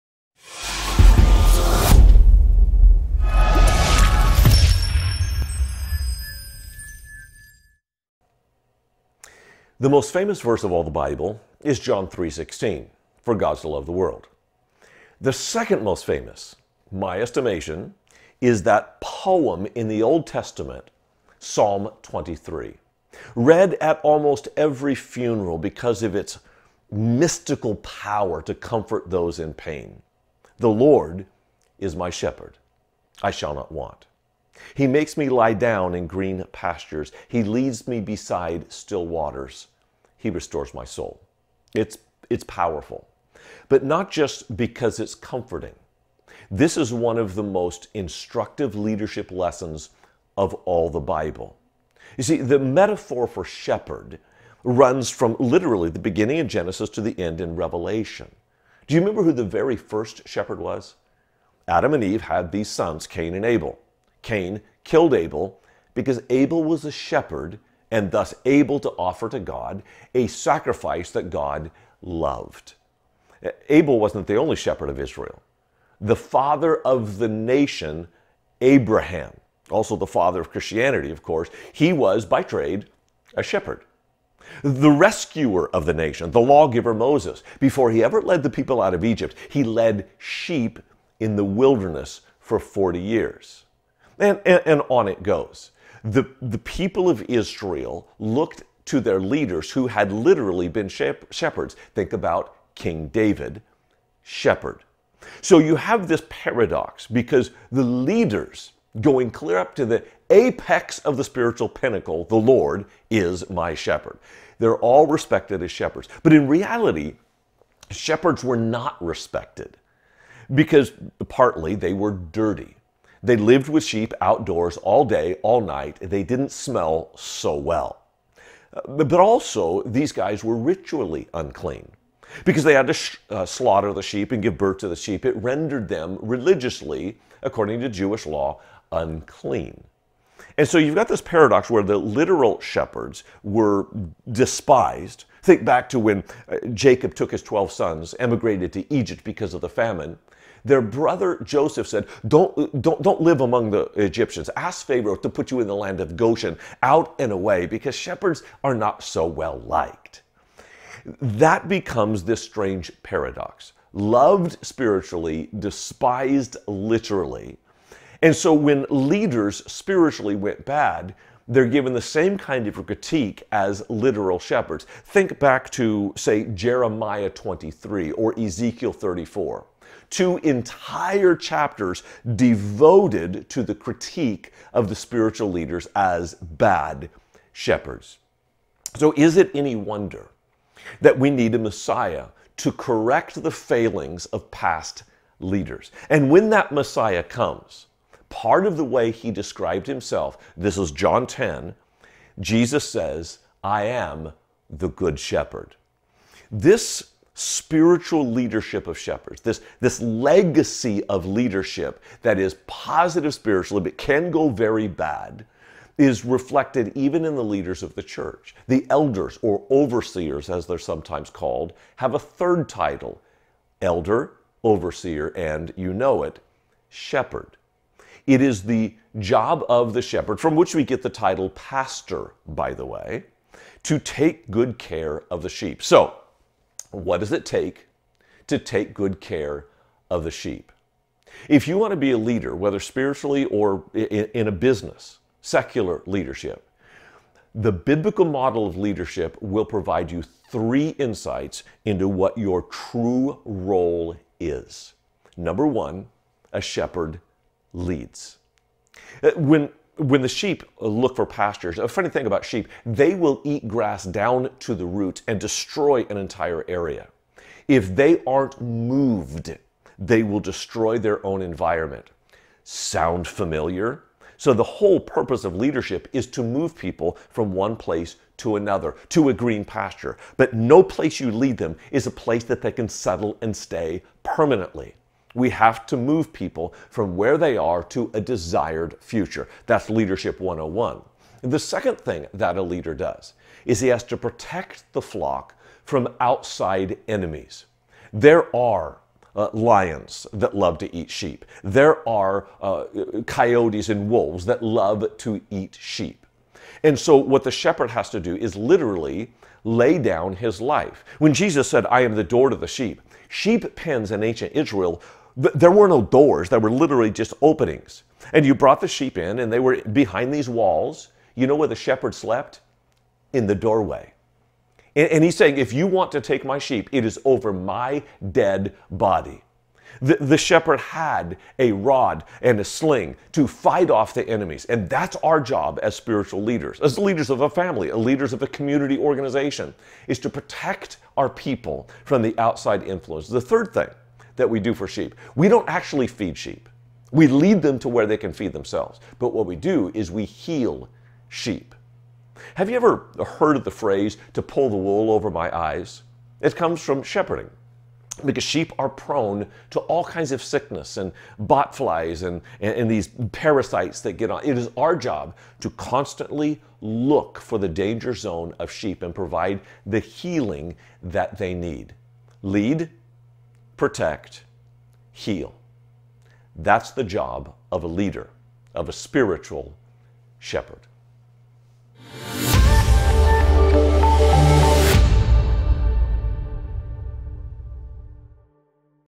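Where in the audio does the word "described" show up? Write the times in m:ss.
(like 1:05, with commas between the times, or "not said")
3:19.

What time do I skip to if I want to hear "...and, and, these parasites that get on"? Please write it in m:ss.
6:02.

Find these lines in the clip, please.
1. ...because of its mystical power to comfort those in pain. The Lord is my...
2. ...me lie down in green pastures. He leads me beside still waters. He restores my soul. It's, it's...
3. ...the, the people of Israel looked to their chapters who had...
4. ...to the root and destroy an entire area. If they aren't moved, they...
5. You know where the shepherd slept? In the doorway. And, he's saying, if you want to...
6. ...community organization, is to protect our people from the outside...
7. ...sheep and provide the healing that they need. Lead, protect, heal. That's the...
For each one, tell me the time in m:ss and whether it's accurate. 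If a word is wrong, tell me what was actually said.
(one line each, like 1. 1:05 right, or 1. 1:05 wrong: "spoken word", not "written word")
1. 0:25 right
2. 0:35 right
3. 1:36 wrong: "leaders", not "chapters"
4. 4:24 right
5. 5:21 right
6. 5:38 right
7. 6:08 right.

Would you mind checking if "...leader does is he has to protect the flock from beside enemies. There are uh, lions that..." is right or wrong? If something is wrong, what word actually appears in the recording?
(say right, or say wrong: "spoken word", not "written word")
wrong: "outside", not "beside".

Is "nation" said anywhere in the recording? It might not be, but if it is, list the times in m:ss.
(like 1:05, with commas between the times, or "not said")
1:17, 1:25.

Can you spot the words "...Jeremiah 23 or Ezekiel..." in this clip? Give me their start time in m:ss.
2:56.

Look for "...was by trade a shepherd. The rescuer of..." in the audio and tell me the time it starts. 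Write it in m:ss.
1:21.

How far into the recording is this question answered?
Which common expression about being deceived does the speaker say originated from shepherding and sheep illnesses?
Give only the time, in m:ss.
5:54.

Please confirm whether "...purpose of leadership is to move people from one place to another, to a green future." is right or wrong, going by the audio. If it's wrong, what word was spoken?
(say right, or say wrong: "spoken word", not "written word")
wrong: "pasture", not "future".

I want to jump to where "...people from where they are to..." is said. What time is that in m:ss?
4:46.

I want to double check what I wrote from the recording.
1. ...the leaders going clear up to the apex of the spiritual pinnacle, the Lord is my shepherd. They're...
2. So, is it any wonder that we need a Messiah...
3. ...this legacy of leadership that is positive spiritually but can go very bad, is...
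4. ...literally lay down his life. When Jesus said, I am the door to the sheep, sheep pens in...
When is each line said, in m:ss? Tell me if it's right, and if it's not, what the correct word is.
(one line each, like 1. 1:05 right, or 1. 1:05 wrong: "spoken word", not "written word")
1. 1:47 right
2. 3:08 right
3. 3:29 right
4. 5:08 right.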